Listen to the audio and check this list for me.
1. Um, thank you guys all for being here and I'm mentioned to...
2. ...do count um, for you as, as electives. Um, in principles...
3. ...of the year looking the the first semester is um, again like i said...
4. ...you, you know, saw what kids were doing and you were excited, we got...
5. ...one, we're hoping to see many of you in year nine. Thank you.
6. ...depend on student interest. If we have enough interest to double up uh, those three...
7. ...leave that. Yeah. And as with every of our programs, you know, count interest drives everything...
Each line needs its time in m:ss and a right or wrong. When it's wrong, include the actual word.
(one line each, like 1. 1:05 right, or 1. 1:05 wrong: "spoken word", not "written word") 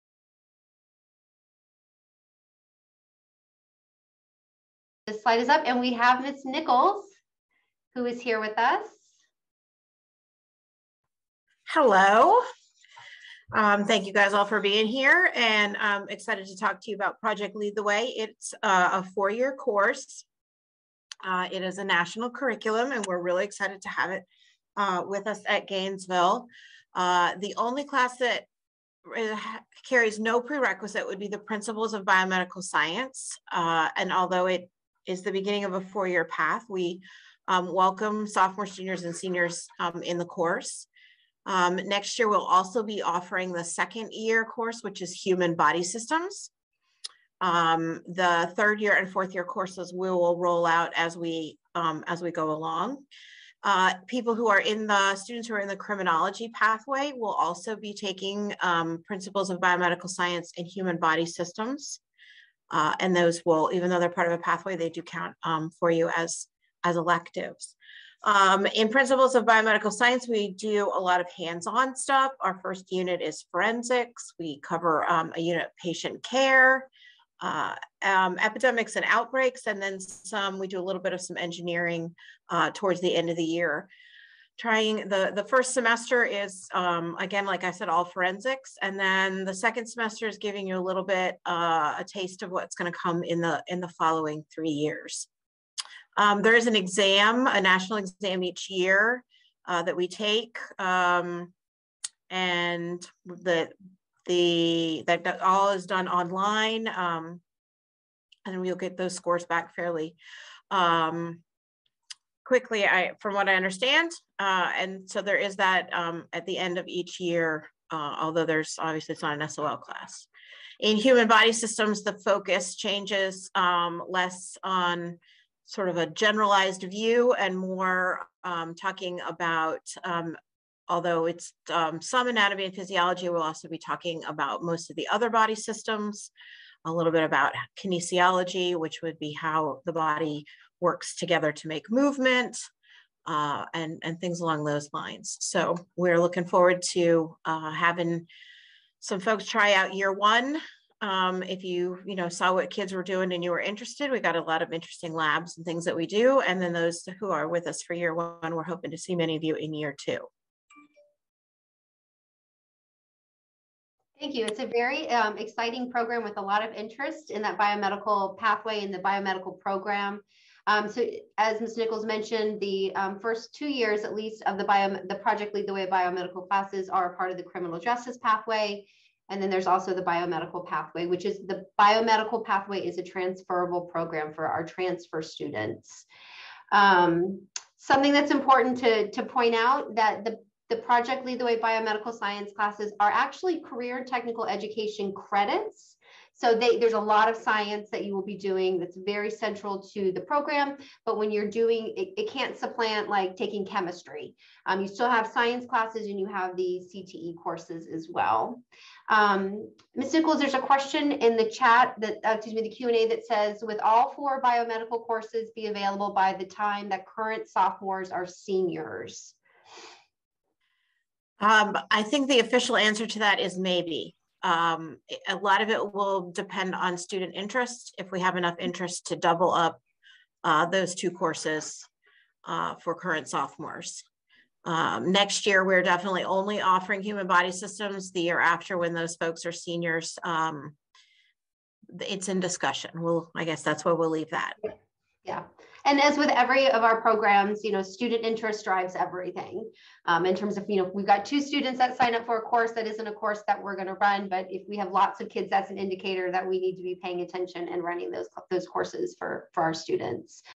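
1. 0:13 wrong: "excited", not "mentioned"
2. 1:04 right
3. 1:23 wrong: "trying", not "looking"
4. 2:31 wrong: "interested", not "excited"
5. 2:38 wrong: "two", not "nine"
6. 3:46 wrong: "two", not "three"
7. 4:04 wrong: "student", not "count".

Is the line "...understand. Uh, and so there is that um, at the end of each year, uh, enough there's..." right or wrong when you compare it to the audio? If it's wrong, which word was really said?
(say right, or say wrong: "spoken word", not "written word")
wrong: "although", not "enough".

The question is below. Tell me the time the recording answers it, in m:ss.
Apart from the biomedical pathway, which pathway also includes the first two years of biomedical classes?
2:57.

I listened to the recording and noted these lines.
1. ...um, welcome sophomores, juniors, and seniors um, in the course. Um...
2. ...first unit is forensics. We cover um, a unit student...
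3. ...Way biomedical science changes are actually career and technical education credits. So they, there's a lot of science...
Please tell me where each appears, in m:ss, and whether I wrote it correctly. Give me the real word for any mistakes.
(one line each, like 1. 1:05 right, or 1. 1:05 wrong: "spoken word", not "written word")
1. 0:37 right
2. 1:12 wrong: "patient", not "student"
3. 3:11 wrong: "classes", not "changes".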